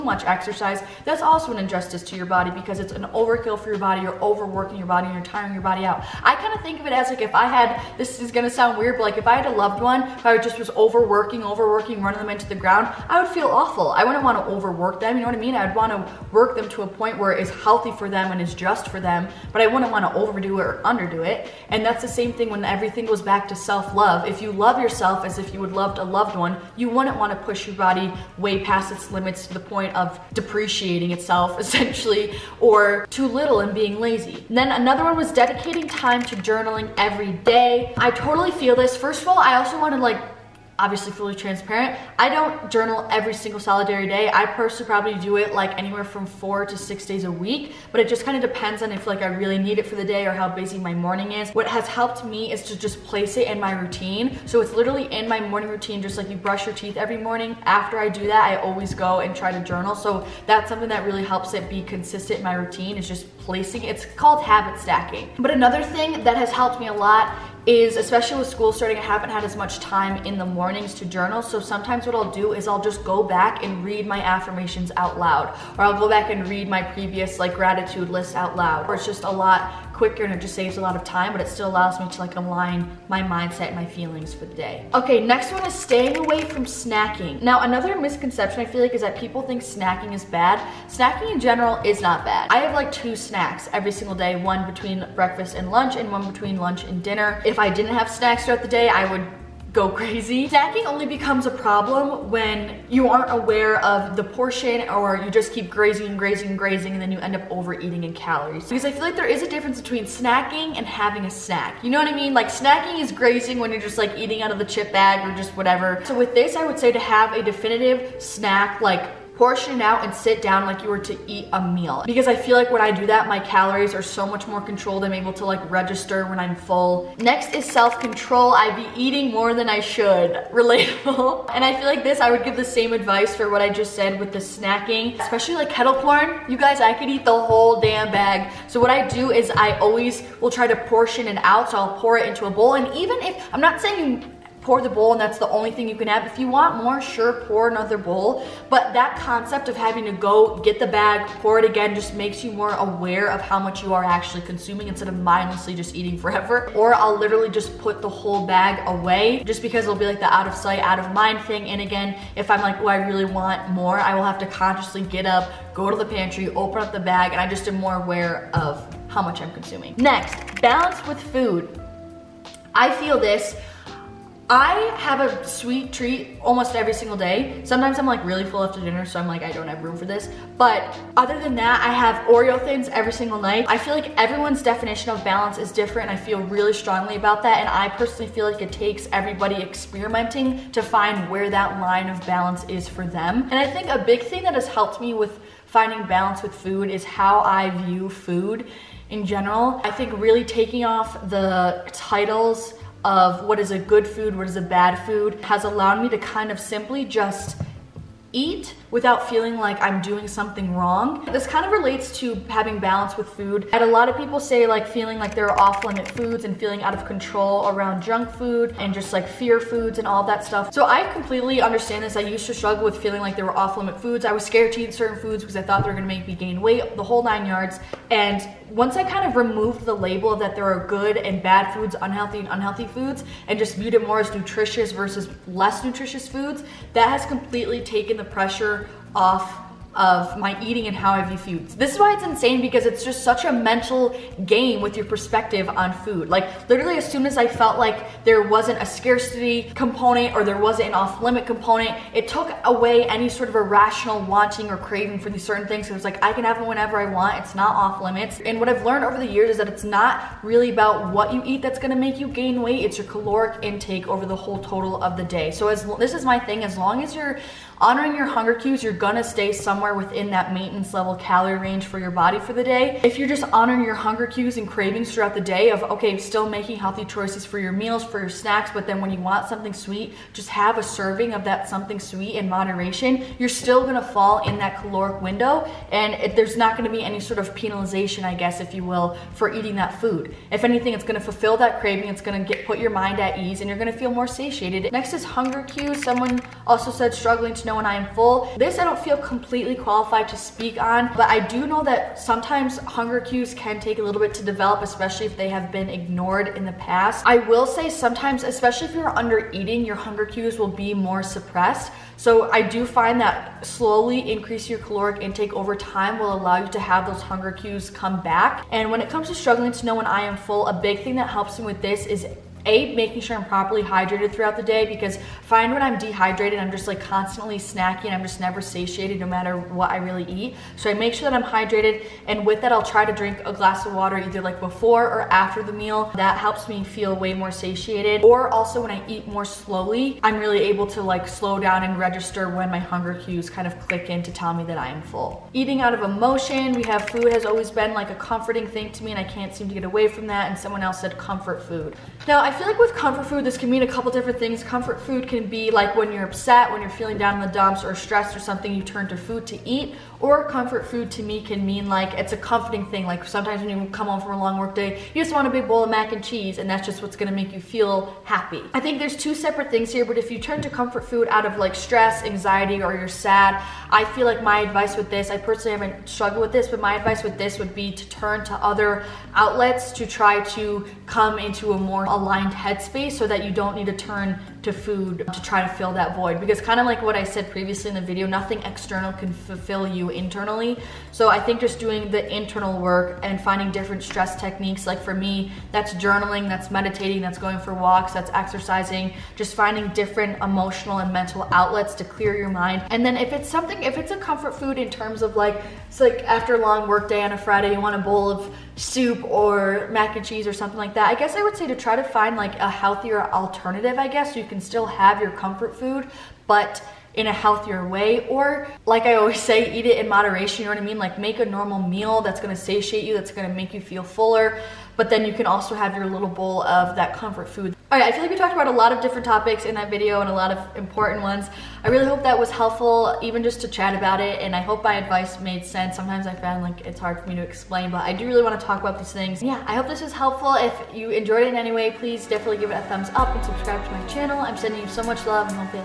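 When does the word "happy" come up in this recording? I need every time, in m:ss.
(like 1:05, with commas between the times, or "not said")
6:08.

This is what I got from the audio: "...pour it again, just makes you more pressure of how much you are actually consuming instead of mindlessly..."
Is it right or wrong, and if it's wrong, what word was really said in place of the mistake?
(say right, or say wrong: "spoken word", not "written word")
wrong: "aware", not "pressure".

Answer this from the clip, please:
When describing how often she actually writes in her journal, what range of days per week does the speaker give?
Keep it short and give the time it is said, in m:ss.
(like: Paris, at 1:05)
4 to 6, at 0:46.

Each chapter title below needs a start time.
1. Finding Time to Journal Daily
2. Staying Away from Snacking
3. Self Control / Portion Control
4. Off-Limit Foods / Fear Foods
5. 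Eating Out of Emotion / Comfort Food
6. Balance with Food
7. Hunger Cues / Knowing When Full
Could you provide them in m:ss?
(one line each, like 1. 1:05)
1. 0:33
2. 1:24
3. 2:06
4. 3:31
5. 5:45
6. 2:49
7. 4:54.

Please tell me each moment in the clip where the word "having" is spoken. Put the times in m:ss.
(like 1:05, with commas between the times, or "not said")
1:50, 2:29, 3:32.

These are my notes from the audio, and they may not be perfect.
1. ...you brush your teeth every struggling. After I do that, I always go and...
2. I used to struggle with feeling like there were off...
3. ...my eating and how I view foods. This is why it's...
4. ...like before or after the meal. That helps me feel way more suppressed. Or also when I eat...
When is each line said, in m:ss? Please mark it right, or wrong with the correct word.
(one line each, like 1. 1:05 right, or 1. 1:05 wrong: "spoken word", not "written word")
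1. 0:56 wrong: "morning", not "struggling"
2. 3:42 right
3. 4:00 right
4. 5:34 wrong: "satiated", not "suppressed".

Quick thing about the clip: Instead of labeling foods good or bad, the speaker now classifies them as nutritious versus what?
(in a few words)
less nutritious.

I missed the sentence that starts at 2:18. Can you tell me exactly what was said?
So what I do is I always will try to portion it out.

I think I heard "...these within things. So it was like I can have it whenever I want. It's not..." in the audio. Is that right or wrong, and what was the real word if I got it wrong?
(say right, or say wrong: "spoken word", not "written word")
wrong: "certain", not "within".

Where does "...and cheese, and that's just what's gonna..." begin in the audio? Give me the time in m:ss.
6:06.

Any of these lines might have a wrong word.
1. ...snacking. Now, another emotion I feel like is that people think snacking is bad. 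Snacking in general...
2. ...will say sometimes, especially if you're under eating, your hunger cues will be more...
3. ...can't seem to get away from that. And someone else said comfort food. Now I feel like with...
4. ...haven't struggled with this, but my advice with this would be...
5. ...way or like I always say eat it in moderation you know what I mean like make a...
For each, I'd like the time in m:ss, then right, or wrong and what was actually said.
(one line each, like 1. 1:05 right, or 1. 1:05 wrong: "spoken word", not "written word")
1. 1:26 wrong: "misconception", not "emotion"
2. 5:07 right
3. 5:49 right
4. 6:15 right
5. 6:57 right.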